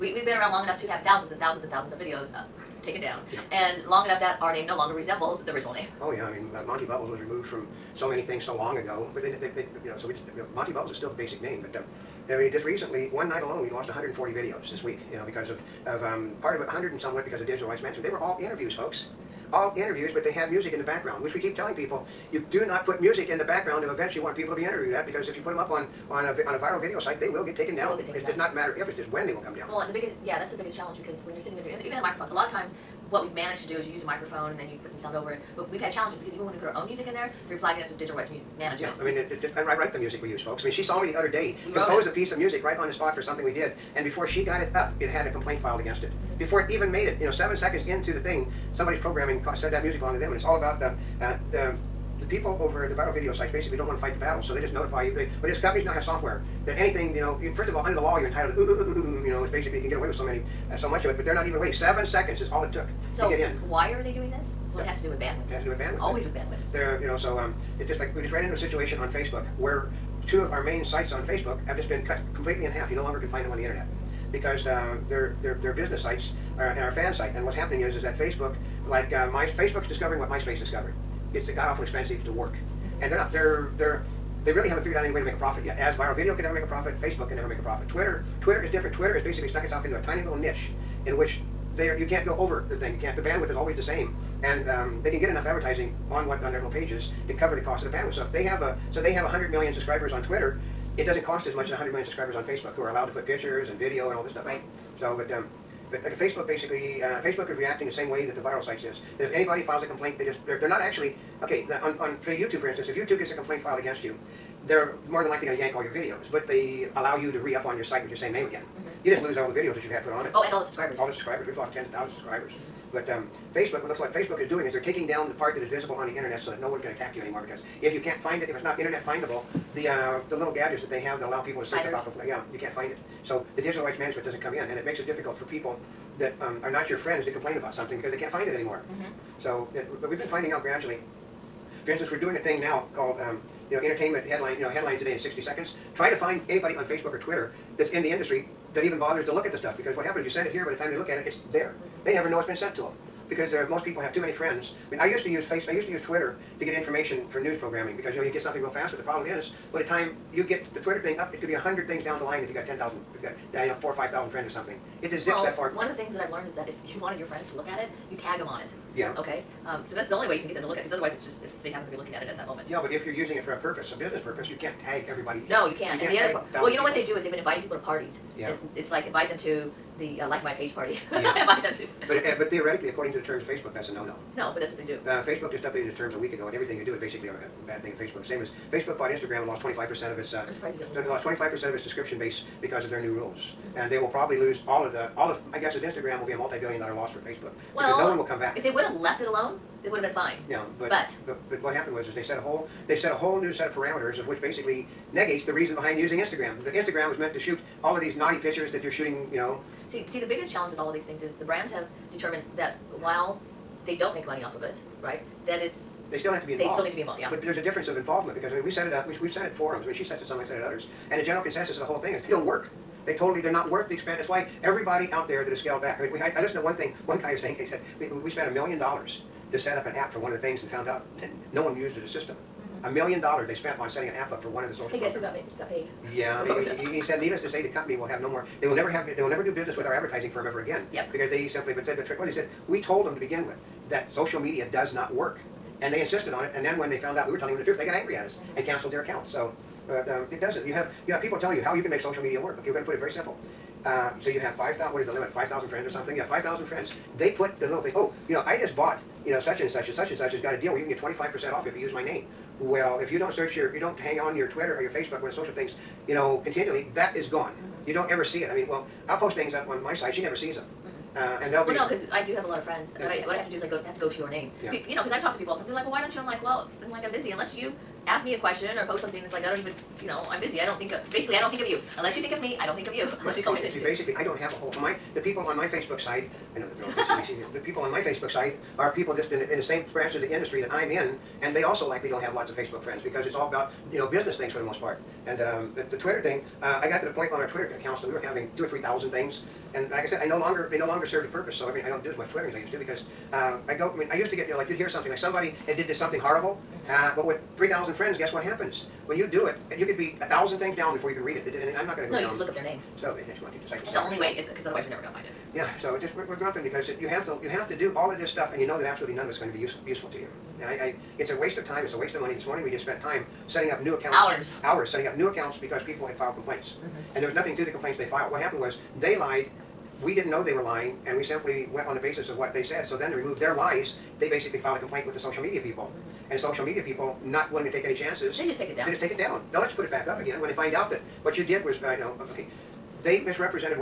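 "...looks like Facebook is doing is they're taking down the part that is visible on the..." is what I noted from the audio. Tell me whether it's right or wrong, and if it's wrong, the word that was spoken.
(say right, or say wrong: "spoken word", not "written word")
right.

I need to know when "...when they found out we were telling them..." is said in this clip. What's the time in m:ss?
4:06.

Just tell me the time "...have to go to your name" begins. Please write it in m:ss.
4:33.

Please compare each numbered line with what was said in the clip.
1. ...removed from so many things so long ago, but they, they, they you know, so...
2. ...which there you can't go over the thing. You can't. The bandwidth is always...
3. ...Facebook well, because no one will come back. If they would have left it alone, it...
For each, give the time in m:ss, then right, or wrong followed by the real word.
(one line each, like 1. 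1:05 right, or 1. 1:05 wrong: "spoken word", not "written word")
1. 0:07 right
2. 1:31 right
3. 3:17 right.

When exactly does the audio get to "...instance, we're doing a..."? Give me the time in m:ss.
2:21.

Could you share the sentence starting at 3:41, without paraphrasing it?
And the general consensus of the whole thing is they don't work.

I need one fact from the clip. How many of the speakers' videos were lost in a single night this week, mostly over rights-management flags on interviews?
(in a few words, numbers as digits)
140.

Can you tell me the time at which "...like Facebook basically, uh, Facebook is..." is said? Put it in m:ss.
1:46.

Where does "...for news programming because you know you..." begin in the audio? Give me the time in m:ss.
2:37.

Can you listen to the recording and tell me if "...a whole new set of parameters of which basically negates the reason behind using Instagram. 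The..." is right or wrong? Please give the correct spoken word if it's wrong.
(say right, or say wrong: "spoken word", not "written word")
right.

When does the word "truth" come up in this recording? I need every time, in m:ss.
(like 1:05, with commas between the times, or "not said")
4:07.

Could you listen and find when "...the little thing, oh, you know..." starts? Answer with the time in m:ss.
4:17.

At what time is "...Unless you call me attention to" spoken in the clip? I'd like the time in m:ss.
4:43.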